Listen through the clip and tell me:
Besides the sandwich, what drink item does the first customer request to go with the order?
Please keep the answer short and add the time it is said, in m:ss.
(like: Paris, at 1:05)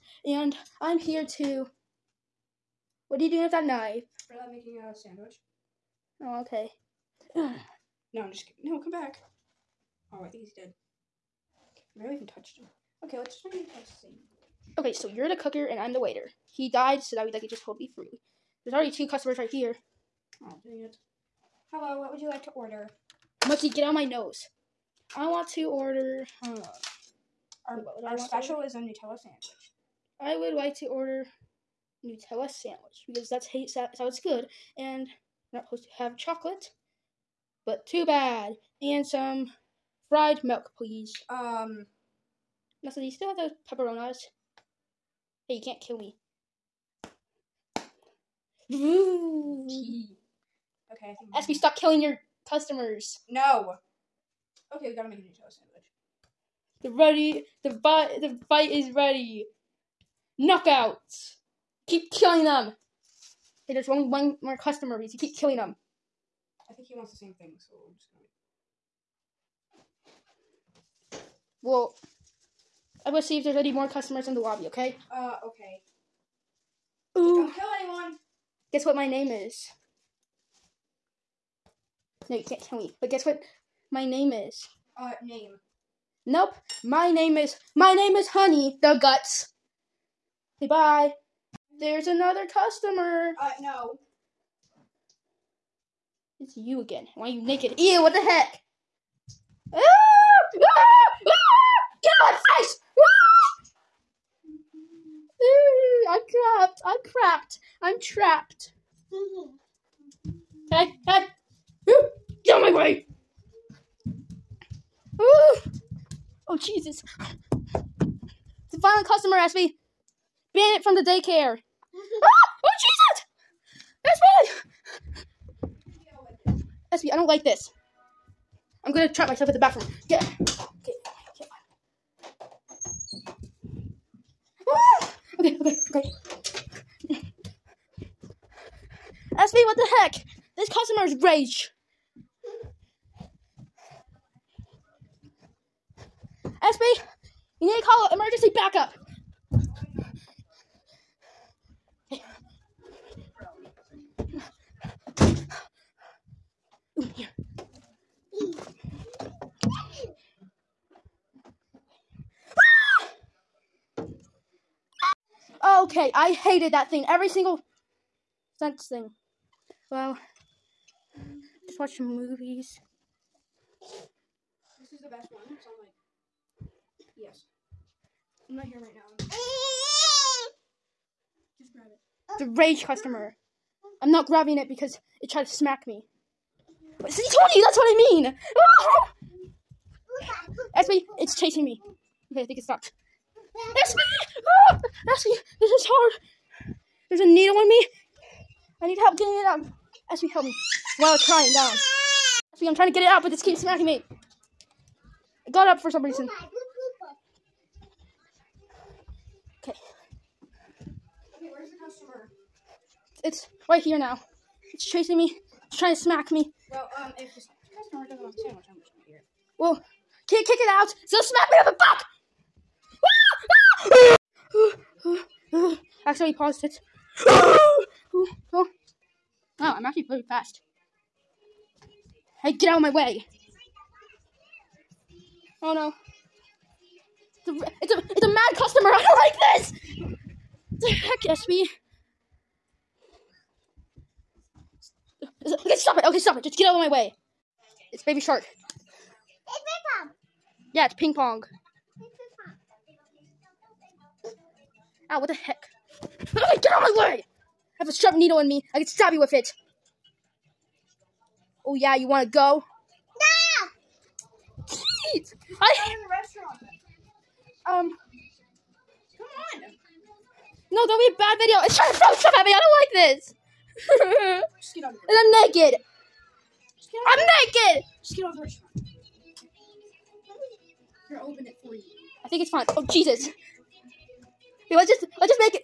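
fried milk, at 0:40.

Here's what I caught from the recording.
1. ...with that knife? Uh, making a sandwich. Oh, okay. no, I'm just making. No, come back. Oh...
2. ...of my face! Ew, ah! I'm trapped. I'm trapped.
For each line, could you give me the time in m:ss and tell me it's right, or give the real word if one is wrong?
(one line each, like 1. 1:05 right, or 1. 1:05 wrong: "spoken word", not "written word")
1. 0:03 wrong: "kidding", not "making"
2. 1:42 right.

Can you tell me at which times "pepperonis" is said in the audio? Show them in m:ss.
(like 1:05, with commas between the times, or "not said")
0:43.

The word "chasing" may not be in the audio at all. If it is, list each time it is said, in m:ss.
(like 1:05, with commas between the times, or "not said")
3:11, 3:34.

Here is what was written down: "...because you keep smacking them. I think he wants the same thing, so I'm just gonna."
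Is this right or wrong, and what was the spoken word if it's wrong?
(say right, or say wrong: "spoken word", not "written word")
wrong: "killing", not "smacking".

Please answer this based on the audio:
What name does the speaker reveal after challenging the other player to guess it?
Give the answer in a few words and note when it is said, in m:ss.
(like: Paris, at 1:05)
Honey the Guts, at 1:28.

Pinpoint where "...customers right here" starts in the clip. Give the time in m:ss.
0:19.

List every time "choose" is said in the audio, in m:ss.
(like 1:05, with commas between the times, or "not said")
not said.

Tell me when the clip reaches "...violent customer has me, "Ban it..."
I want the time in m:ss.
1:58.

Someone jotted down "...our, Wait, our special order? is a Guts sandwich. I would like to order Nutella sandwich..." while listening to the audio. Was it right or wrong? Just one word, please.
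wrong.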